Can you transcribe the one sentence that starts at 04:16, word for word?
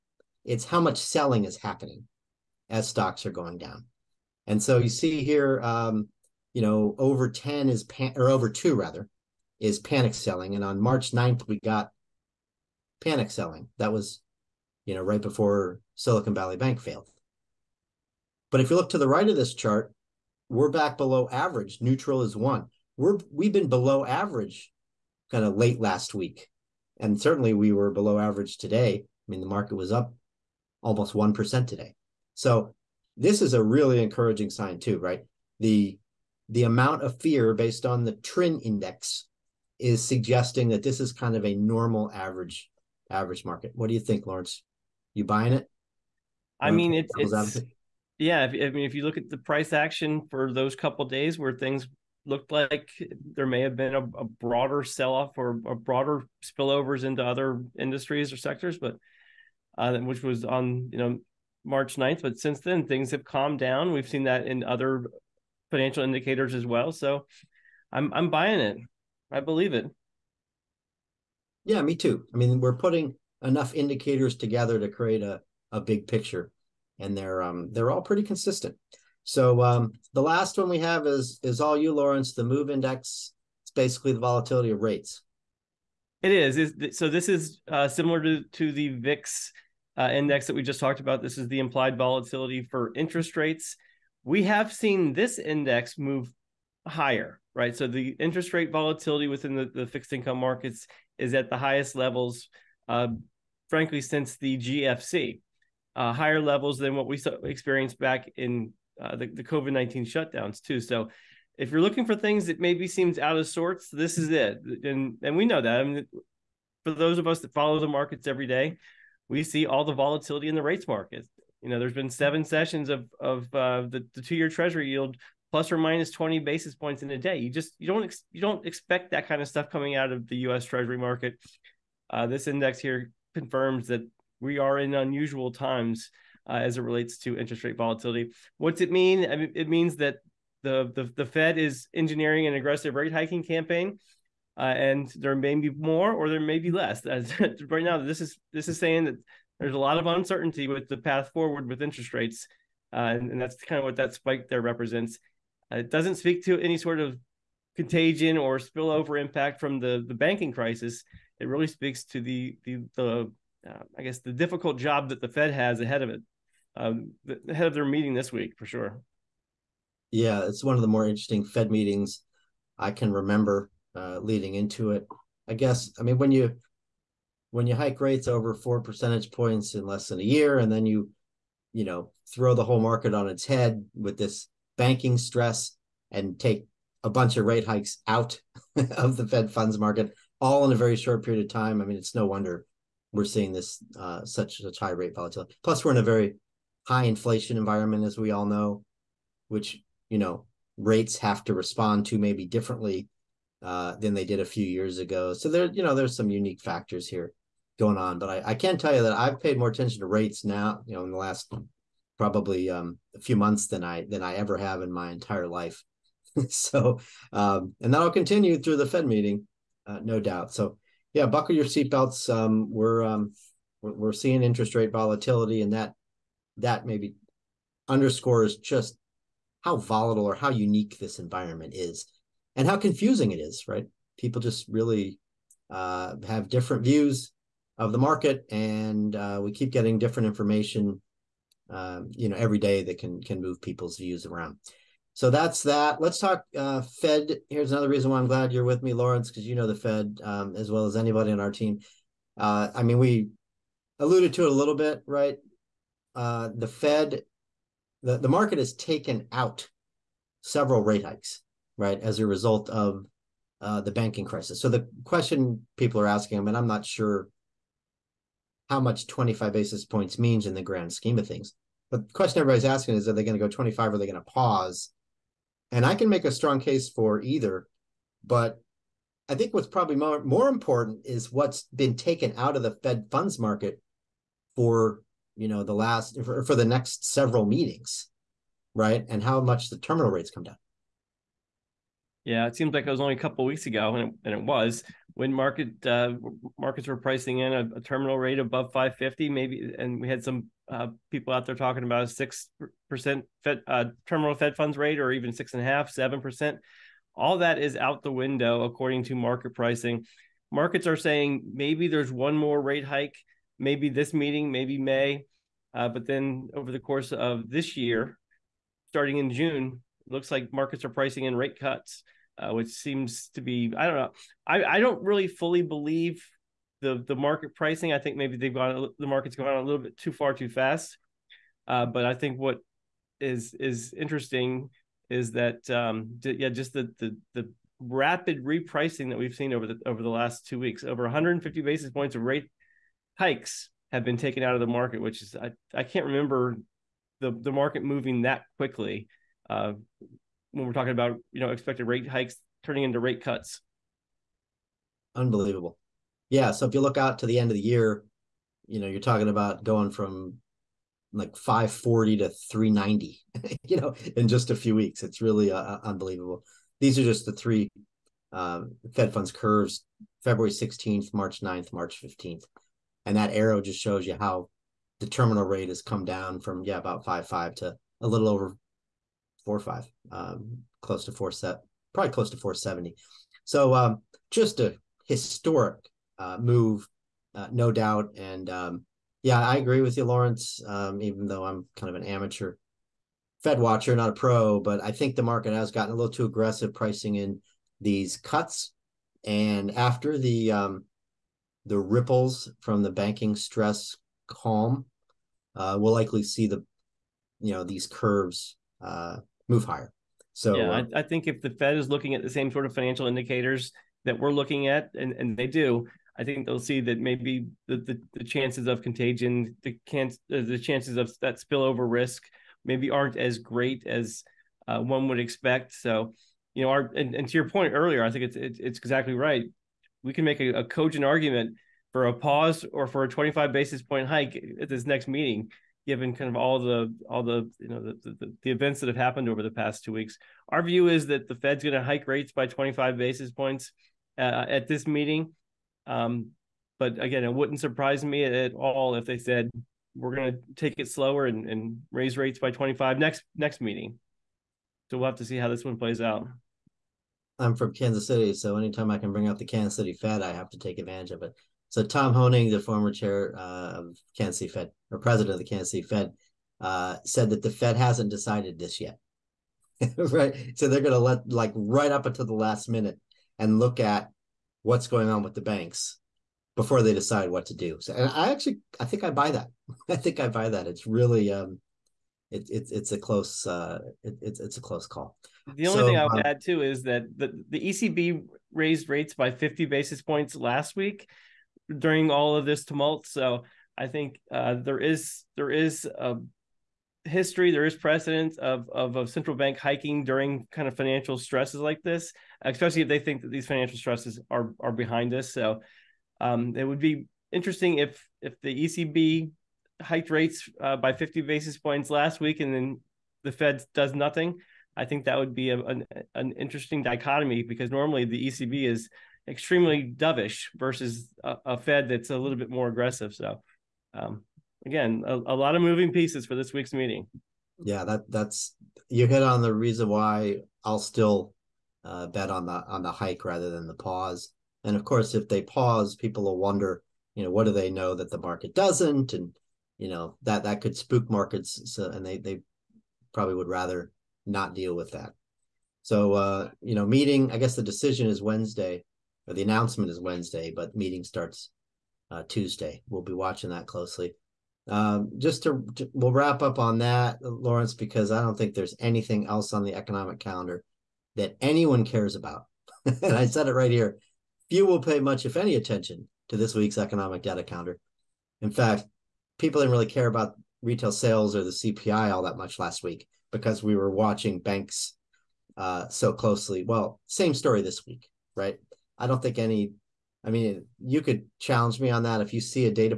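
Uh, the Fed, the, the market has taken out several rate hikes, right, as a result of uh, the banking crisis.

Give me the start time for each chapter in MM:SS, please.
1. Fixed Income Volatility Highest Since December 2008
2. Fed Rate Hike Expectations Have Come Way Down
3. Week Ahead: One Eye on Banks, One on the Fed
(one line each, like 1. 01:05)
1. 01:19
2. 04:07
3. 09:13.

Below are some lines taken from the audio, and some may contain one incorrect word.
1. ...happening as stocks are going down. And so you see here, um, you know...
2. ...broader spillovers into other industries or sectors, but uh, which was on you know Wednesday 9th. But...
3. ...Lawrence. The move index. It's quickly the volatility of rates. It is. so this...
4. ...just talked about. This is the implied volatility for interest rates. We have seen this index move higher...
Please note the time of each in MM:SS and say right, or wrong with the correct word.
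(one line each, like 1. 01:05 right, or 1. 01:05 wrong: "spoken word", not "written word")
1. 00:01 right
2. 00:55 wrong: "March", not "Wednesday"
3. 01:21 wrong: "basically", not "quickly"
4. 01:30 right.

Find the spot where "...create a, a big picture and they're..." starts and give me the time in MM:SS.
01:14.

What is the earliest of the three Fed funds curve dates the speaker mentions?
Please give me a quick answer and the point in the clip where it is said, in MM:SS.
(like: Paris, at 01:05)
February 16th, at 06:10.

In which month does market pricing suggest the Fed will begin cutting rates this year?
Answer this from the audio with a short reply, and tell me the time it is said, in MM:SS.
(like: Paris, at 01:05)
June, at 05:18.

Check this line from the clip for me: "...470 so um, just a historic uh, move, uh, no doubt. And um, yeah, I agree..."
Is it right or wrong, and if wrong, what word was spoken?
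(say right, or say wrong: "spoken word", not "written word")
right.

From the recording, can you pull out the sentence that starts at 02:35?
Uh, it doesn't speak to any sort of contagion or spillover impact from the the banking crisis.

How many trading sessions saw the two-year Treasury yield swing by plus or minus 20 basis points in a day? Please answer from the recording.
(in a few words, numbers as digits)
7.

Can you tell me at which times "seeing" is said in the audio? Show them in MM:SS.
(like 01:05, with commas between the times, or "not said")
03:13, 03:44.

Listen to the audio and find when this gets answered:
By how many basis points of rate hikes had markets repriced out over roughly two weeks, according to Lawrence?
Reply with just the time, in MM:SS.
05:40.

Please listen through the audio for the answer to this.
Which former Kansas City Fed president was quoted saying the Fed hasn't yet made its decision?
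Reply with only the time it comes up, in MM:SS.
07:41.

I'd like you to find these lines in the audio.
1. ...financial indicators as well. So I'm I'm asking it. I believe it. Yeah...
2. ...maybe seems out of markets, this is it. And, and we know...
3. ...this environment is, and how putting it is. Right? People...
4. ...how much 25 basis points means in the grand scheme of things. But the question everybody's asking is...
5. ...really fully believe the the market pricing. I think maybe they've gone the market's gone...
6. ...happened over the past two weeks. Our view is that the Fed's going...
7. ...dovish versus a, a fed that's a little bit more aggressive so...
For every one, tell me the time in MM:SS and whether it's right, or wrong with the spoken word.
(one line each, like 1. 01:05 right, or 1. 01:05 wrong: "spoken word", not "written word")
1. 01:05 wrong: "buying", not "asking"
2. 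01:52 wrong: "sorts", not "markets"
3. 03:50 wrong: "confusing", not "putting"
4. 04:28 right
5. 05:25 right
6. 07:18 right
7. 08:39 right.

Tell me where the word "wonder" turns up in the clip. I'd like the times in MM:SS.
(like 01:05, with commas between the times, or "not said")
03:12, 08:56.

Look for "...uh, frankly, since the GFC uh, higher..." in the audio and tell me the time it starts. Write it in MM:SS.
01:42.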